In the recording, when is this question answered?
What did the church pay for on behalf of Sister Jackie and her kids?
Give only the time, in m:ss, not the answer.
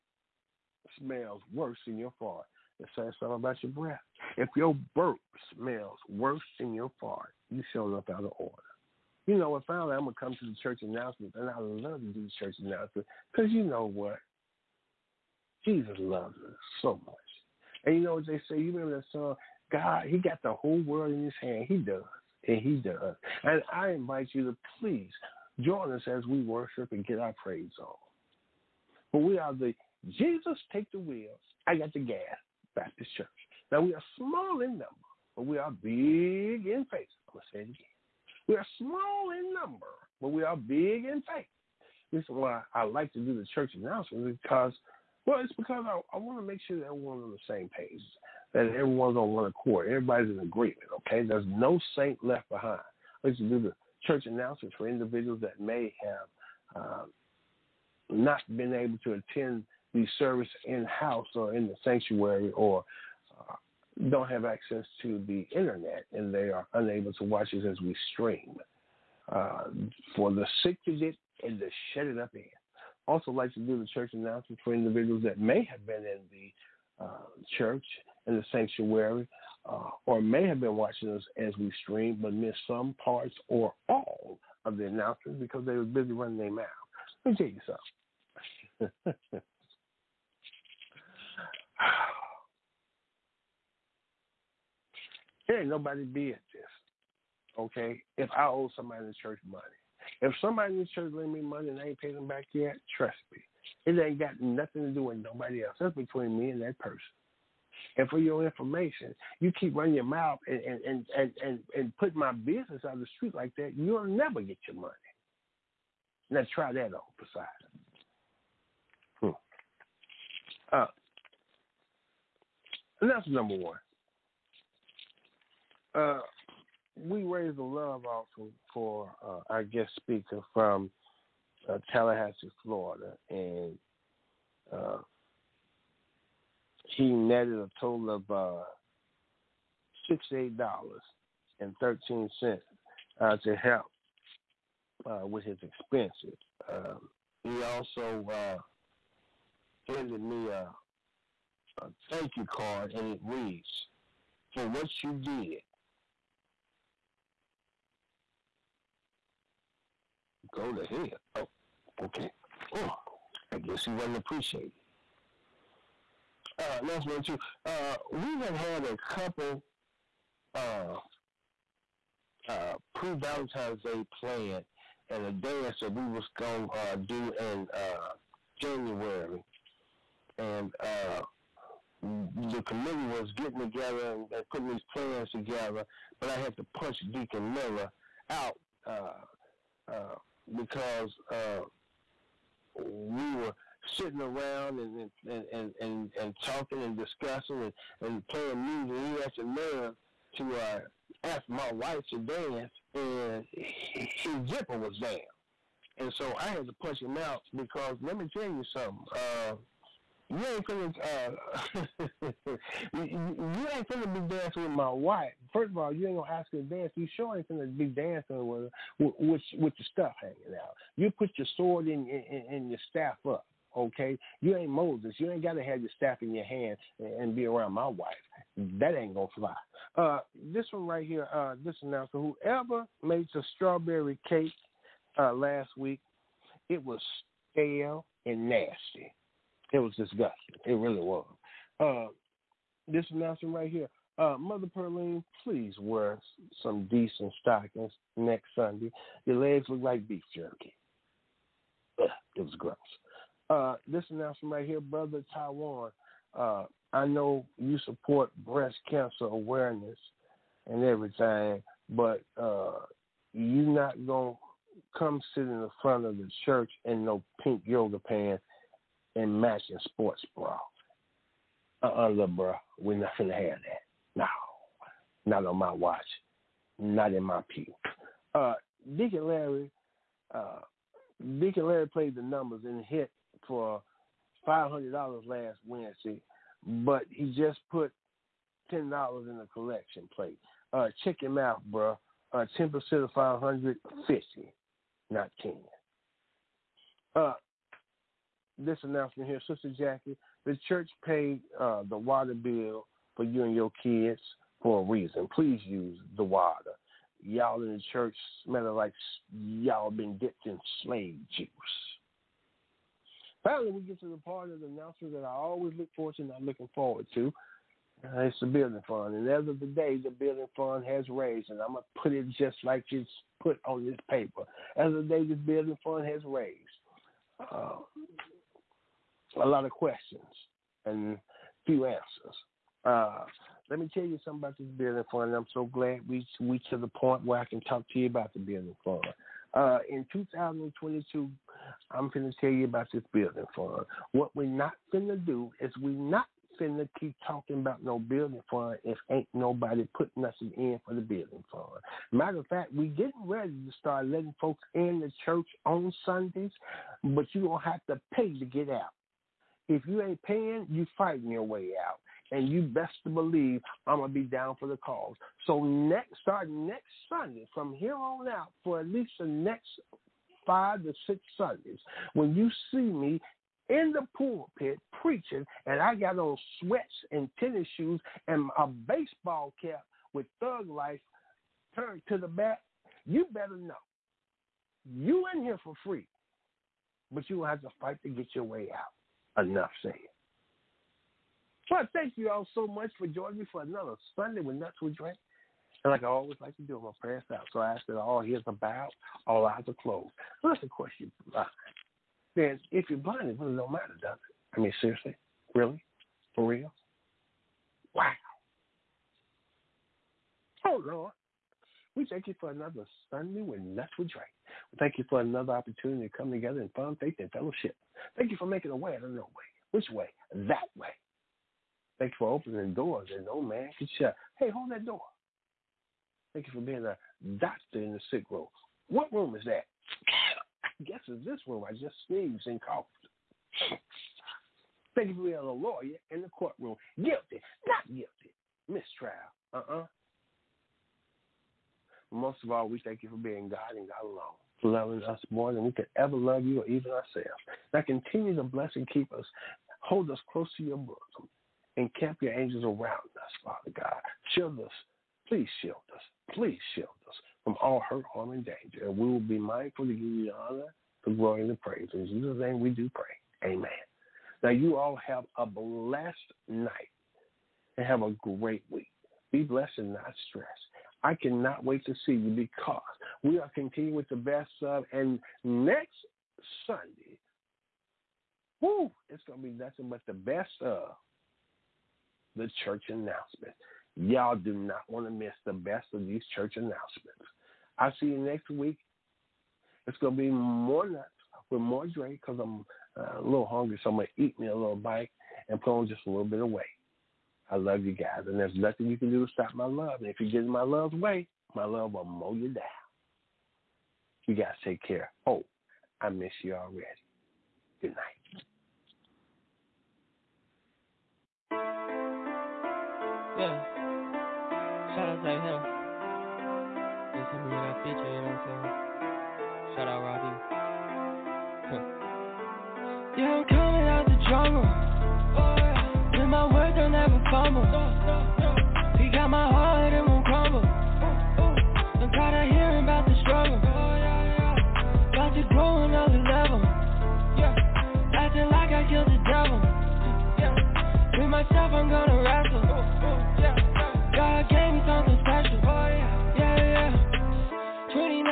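5:01.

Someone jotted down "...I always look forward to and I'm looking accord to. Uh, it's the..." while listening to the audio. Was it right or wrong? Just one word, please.
wrong.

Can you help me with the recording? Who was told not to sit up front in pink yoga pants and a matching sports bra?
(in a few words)
Brother Taiwan.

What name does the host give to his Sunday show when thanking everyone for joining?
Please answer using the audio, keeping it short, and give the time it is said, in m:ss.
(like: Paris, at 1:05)
Nuts with Dre, at 6:34.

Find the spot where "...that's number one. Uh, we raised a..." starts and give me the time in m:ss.
2:03.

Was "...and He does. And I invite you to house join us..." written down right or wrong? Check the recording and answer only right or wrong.
wrong.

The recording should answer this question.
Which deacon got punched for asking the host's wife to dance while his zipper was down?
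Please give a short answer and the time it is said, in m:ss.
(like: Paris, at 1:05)
Deacon Miller, at 3:07.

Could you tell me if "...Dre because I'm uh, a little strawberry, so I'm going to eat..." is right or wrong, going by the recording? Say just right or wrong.
wrong.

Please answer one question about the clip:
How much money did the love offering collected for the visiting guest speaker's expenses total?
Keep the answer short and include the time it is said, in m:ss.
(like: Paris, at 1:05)
$68.13, at 2:20.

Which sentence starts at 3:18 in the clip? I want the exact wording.
He had the nerve to uh, ask my wife to dance, and his zipper was down.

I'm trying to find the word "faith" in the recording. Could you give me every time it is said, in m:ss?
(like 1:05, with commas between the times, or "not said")
0:36, 0:41, 6:56.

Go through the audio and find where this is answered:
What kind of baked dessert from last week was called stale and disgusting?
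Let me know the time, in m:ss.
3:53.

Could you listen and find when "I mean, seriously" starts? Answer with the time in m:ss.
6:44.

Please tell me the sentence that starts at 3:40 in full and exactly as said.
You put your sword in your staff up.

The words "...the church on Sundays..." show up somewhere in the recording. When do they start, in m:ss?
5:54.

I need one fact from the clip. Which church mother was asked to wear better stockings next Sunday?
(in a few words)
Mother Perlene.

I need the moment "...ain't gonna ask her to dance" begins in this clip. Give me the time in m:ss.
3:36.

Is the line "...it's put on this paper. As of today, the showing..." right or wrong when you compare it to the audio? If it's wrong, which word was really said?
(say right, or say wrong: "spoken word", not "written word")
wrong: "building", not "showing".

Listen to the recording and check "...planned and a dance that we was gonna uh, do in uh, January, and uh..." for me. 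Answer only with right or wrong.
right.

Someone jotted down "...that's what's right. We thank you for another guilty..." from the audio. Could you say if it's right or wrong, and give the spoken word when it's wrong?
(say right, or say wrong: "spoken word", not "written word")
wrong: "opportunity", not "guilty".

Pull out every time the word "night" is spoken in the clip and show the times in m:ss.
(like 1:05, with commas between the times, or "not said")
7:46, 8:27.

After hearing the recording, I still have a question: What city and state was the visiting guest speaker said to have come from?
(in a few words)
Tallahassee, Florida.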